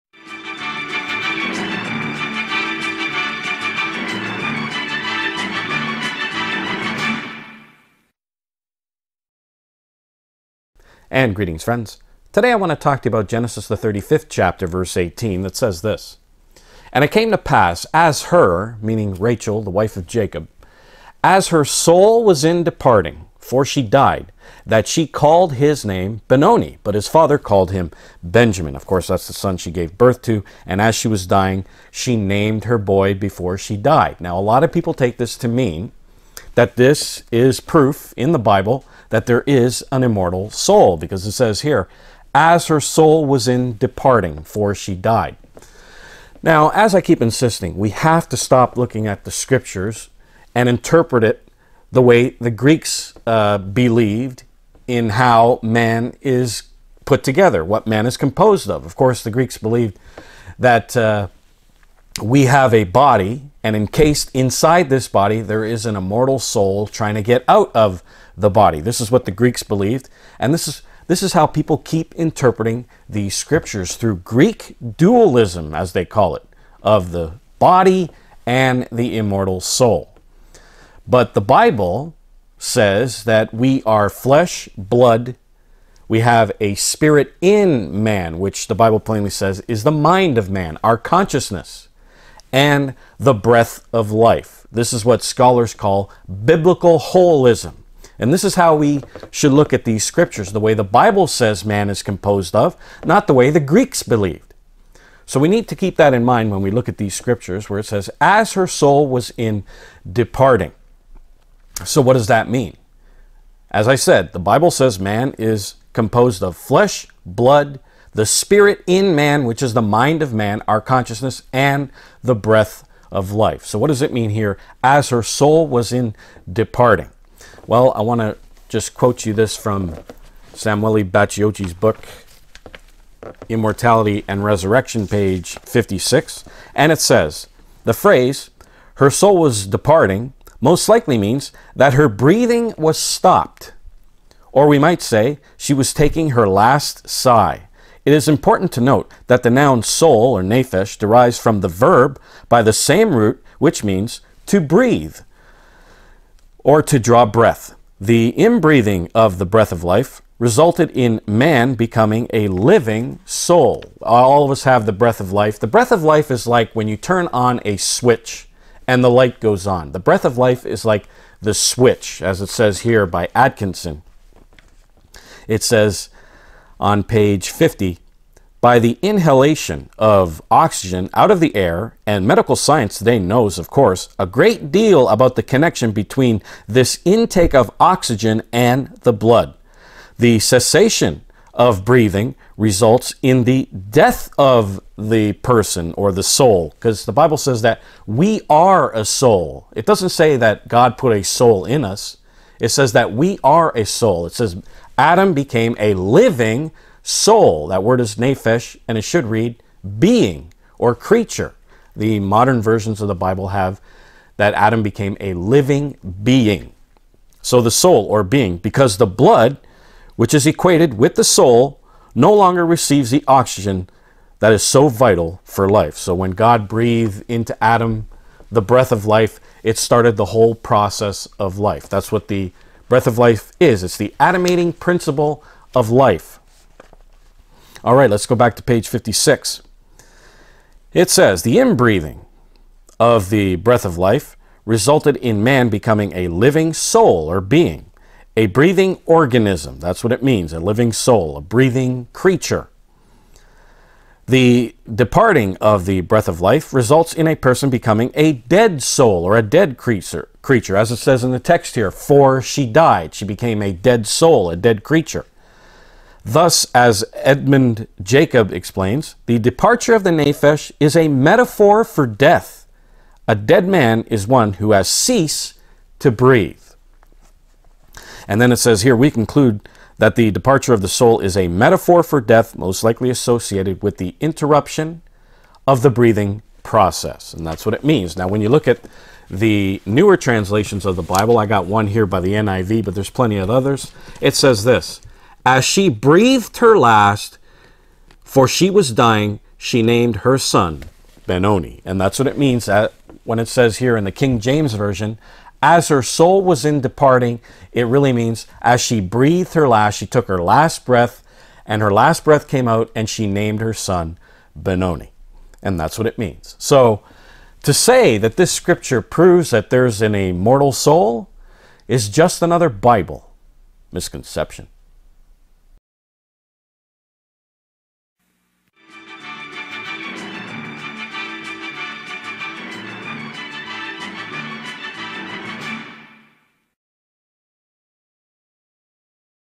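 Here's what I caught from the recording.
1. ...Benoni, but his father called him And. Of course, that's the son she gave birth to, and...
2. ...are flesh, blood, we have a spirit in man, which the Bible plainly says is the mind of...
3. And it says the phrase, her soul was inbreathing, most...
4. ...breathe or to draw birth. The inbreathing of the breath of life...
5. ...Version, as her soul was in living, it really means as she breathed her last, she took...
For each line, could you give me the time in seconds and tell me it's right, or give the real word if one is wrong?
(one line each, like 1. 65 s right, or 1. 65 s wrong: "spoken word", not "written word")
1. 26 s wrong: "Benjamin", not "And"
2. 83 s right
3. 136 s wrong: "departing", not "inbreathing"
4. 154 s wrong: "breath", not "birth"
5. 304 s wrong: "departing", not "living".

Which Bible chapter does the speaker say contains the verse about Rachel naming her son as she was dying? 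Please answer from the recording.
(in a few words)
35th chapter.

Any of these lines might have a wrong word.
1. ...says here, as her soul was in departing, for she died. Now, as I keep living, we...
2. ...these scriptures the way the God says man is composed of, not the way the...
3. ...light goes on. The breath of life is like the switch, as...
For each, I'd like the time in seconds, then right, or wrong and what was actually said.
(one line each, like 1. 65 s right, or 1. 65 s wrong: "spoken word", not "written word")
1. 41 s wrong: "insisting", not "living"
2. 99 s wrong: "Bible", not "God"
3. 169 s right.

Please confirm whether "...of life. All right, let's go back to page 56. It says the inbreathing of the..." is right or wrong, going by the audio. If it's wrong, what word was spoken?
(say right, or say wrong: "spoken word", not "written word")
right.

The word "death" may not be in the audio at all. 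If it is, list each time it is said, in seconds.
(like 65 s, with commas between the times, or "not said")
193 s, 272 s, 282 s.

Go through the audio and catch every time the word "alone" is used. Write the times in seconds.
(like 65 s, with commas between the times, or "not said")
not said.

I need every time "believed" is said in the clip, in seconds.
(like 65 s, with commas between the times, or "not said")
53 s, 59 s, 69 s, 104 s.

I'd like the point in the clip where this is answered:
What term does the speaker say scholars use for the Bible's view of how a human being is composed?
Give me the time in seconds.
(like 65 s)
96 s.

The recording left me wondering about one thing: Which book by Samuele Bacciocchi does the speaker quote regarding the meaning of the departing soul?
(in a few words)
Immortality and Resurrection.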